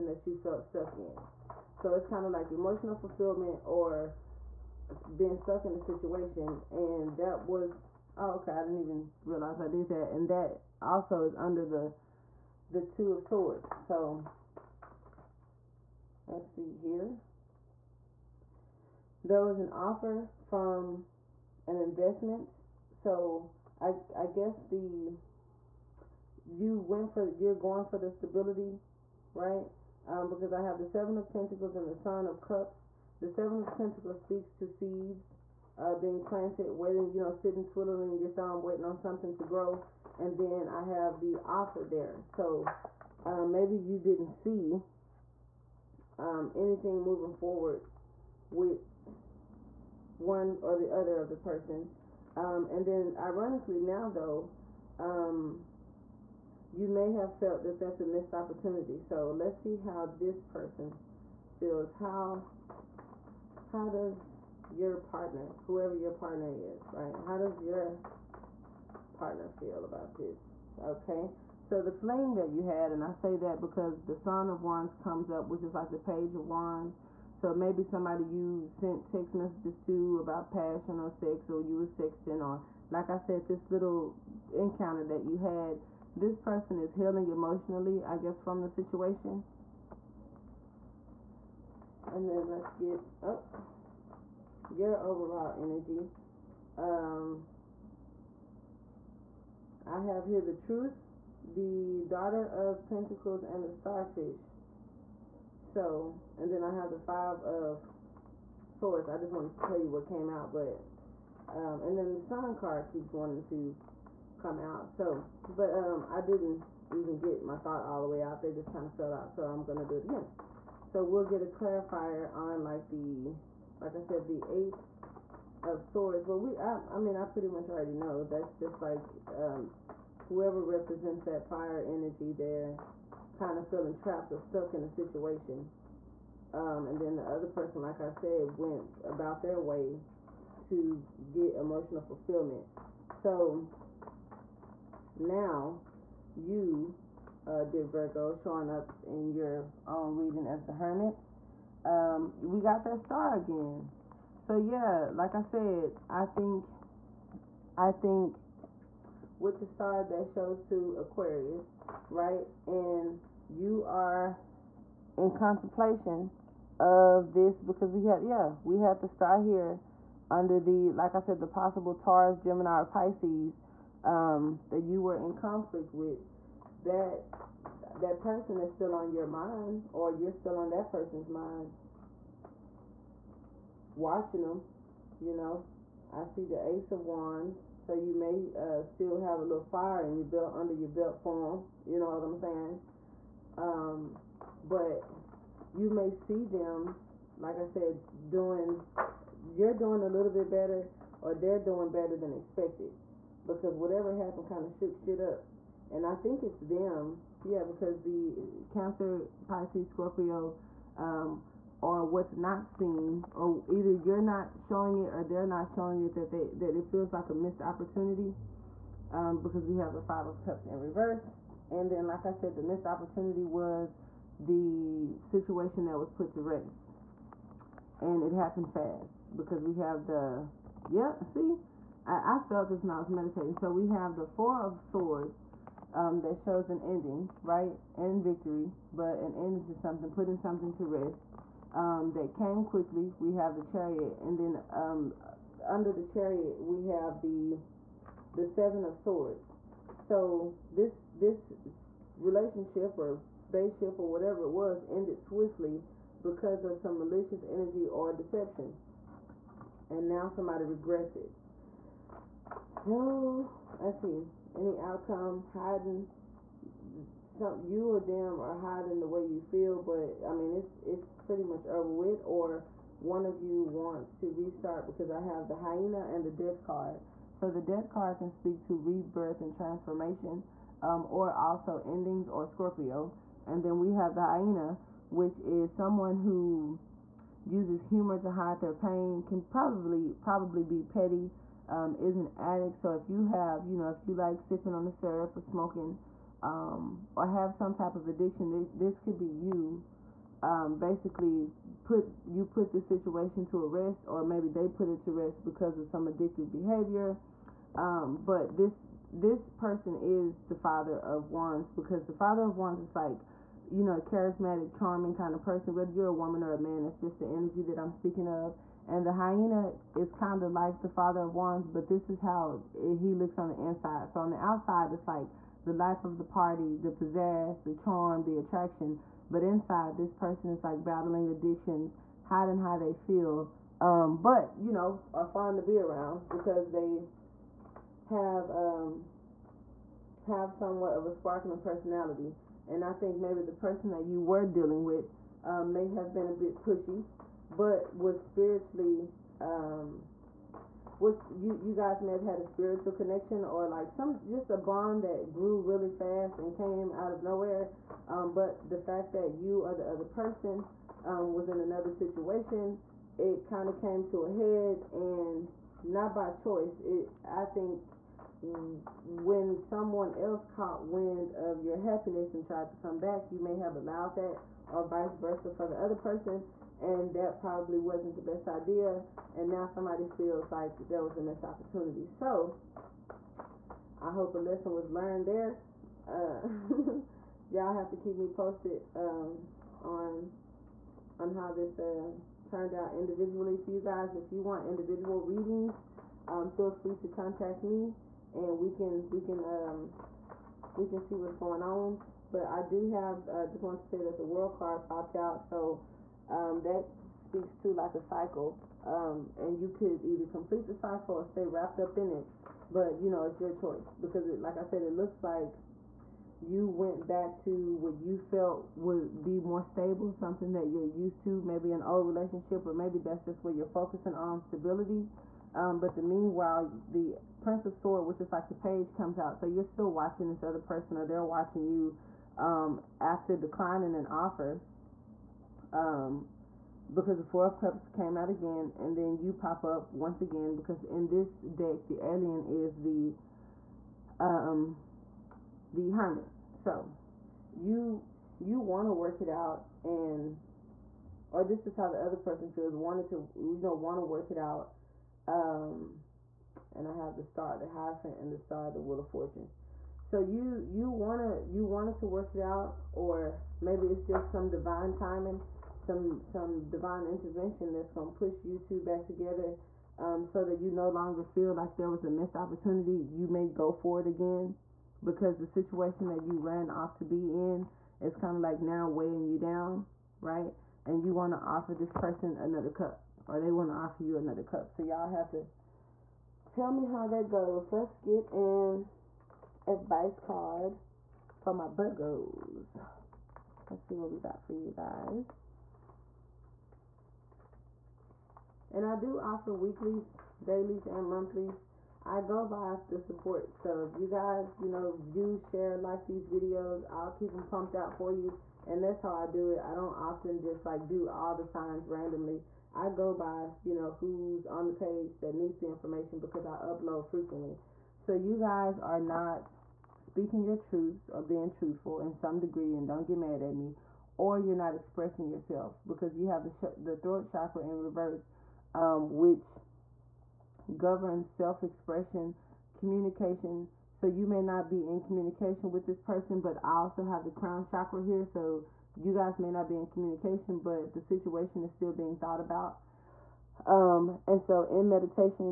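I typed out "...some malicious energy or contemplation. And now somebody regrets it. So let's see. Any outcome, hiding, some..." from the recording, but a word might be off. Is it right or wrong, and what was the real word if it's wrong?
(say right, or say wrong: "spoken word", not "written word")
wrong: "deception", not "contemplation".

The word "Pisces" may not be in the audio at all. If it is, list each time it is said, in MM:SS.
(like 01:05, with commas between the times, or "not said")
02:52, 03:29.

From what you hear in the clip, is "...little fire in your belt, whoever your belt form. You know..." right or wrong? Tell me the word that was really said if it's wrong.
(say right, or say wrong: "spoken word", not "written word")
wrong: "under", not "whoever".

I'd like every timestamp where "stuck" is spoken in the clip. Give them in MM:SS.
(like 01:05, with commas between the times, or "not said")
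00:00, 00:05, 02:14.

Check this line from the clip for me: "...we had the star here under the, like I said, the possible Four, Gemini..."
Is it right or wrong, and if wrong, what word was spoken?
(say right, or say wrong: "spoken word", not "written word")
wrong: "Taurus", not "Four".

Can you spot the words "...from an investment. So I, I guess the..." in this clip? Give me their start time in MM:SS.
00:20.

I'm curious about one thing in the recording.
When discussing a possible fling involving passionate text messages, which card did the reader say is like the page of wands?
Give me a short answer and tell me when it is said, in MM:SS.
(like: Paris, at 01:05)
Son of Wands, at 01:14.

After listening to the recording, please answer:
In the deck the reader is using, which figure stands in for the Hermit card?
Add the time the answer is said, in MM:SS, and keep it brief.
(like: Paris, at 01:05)
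The alien, at 07:21.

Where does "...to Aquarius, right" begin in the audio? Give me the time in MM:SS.
02:40.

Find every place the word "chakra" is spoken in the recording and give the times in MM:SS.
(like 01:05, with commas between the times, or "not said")
08:47, 08:57.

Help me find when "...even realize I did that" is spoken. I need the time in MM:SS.
00:08.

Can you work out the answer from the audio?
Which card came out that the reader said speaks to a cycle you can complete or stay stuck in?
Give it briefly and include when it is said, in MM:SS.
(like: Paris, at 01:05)
The World, at 06:44.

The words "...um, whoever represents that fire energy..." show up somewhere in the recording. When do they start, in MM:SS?
02:09.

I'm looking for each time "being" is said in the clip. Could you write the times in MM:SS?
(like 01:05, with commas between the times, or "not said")
00:05, 00:35, 08:41, 09:01.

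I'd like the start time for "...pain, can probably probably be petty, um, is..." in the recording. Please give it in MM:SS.
04:48.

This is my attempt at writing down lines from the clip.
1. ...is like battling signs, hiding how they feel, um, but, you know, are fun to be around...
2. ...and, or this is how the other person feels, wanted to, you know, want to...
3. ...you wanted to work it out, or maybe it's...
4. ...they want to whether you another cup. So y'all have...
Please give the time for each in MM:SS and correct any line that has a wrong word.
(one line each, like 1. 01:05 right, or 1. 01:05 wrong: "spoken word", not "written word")
1. 05:30 wrong: "addictions", not "signs"
2. 07:29 right
3. 07:41 right
4. 08:03 wrong: "offer", not "whether".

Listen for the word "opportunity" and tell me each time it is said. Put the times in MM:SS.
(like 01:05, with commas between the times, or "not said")
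00:58, 03:37, 03:42, 06:21, 07:52.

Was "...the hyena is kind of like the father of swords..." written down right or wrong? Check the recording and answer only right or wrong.
wrong.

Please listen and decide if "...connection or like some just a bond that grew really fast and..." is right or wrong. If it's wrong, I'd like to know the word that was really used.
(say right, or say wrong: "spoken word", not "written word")
right.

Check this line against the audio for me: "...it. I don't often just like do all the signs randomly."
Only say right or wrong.
right.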